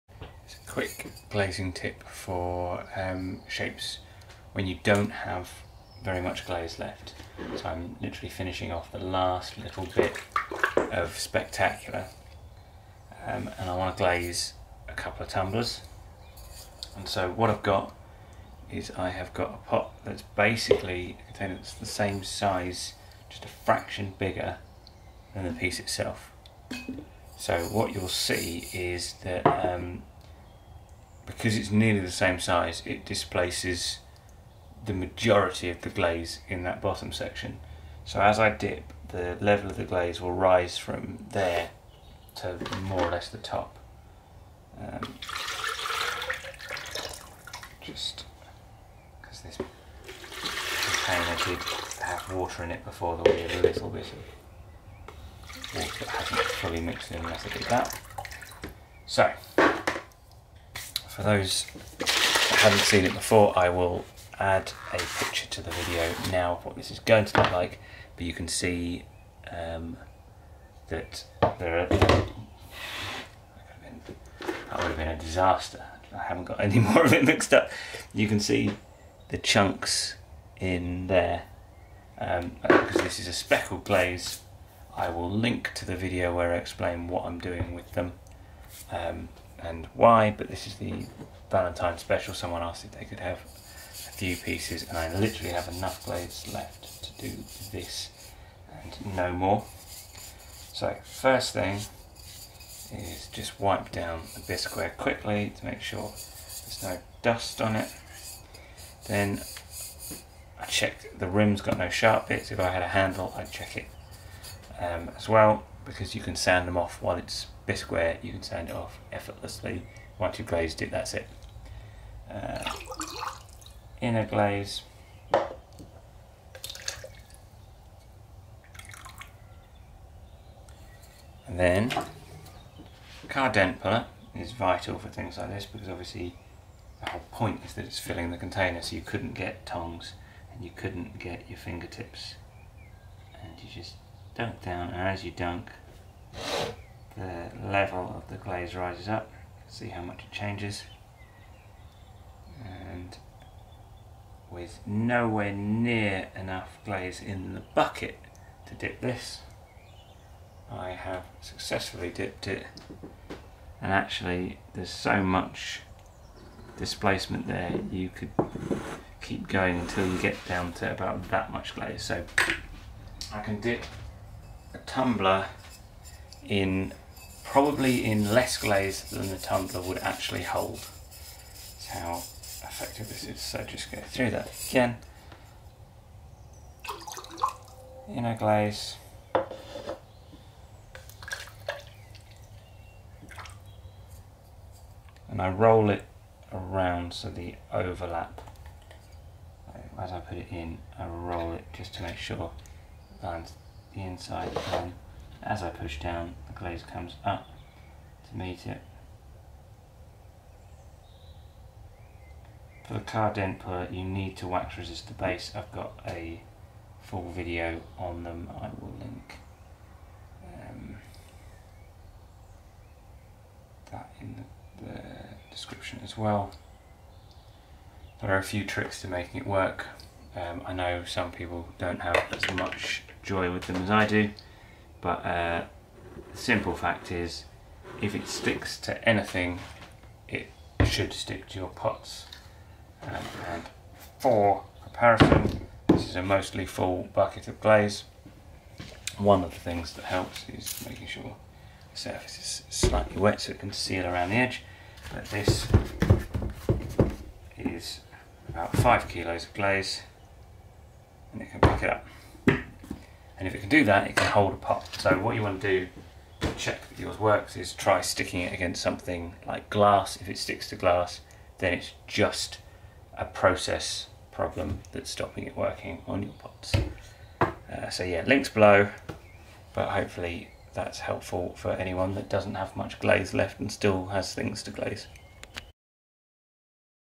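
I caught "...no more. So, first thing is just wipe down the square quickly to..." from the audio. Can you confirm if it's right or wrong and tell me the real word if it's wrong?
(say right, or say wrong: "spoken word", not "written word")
right.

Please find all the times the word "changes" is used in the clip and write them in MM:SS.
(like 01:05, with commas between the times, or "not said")
02:30.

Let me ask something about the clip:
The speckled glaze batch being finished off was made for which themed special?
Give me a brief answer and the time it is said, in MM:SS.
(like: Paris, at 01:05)
Valentine special, at 01:31.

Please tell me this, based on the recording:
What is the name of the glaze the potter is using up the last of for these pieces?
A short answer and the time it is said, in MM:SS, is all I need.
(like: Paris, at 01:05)
Spectacular, at 00:11.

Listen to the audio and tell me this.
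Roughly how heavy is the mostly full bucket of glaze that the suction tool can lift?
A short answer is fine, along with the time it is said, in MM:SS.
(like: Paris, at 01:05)
5 kilos, at 04:18.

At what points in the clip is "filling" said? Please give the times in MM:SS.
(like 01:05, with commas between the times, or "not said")
02:17.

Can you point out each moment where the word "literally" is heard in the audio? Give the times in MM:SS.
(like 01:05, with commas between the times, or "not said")
00:08, 01:35.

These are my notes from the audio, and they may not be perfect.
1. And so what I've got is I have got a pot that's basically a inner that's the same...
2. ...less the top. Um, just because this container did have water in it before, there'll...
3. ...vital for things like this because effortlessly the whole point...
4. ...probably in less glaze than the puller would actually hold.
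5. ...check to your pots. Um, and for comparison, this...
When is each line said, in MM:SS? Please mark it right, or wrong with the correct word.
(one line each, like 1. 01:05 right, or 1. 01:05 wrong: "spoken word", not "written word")
1. 00:16 wrong: "container", not "inner"
2. 00:43 right
3. 02:14 wrong: "obviously", not "effortlessly"
4. 02:57 wrong: "tumbler", not "puller"
5. 04:01 wrong: "stick", not "check".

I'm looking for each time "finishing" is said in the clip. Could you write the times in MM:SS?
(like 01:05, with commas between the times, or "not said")
00:08.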